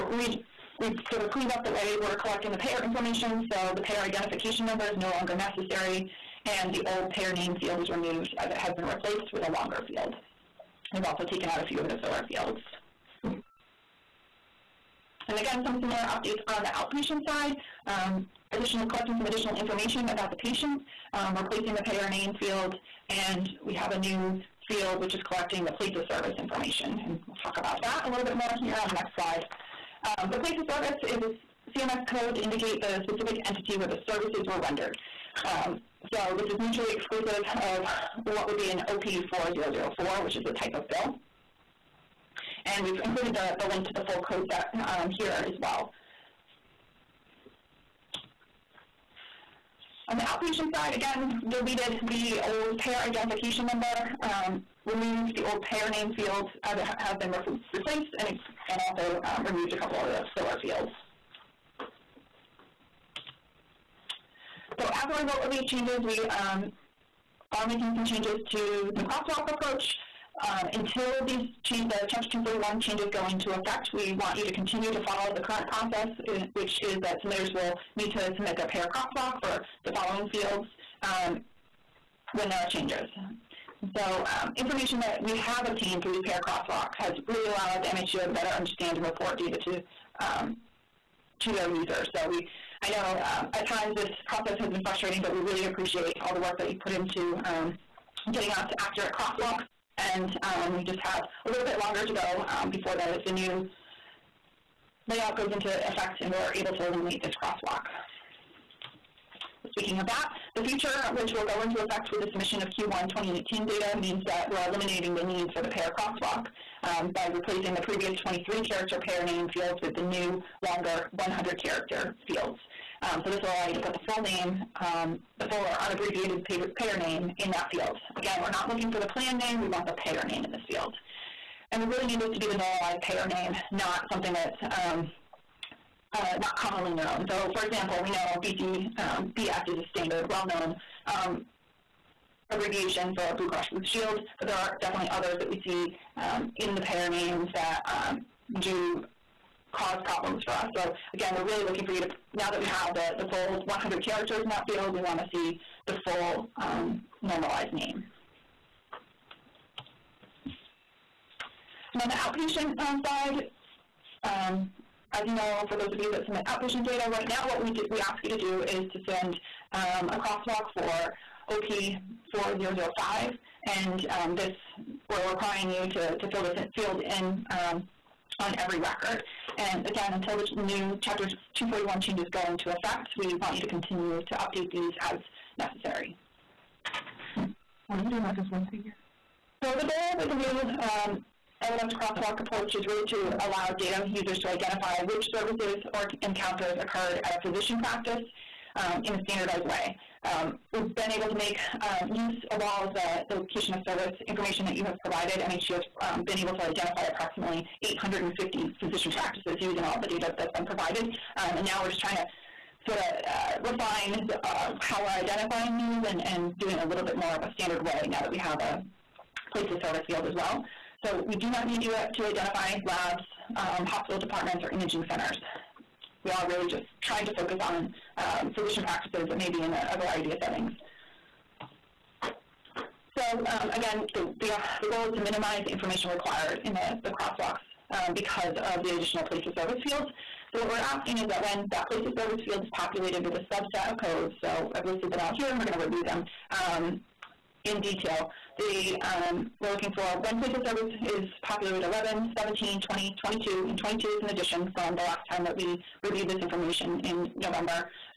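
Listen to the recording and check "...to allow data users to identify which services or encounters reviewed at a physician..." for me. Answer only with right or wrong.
wrong.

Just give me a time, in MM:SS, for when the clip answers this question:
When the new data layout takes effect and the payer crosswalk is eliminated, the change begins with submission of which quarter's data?
01:52.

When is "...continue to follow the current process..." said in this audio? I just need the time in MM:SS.
01:14.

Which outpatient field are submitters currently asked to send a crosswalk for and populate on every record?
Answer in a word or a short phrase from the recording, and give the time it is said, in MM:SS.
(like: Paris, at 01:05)
OP4005, at 02:51.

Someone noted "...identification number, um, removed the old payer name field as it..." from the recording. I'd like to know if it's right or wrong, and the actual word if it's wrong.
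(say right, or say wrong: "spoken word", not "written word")
right.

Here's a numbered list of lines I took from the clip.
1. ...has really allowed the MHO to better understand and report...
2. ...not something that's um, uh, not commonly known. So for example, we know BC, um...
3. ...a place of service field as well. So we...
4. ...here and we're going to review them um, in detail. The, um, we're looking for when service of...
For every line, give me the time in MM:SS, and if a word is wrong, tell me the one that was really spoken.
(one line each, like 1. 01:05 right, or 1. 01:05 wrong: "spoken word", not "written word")
1. 01:26 right
2. 02:13 right
3. 03:38 right
4. 04:05 wrong: "place", not "service".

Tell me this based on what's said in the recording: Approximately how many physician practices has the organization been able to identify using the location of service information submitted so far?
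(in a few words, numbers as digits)
850.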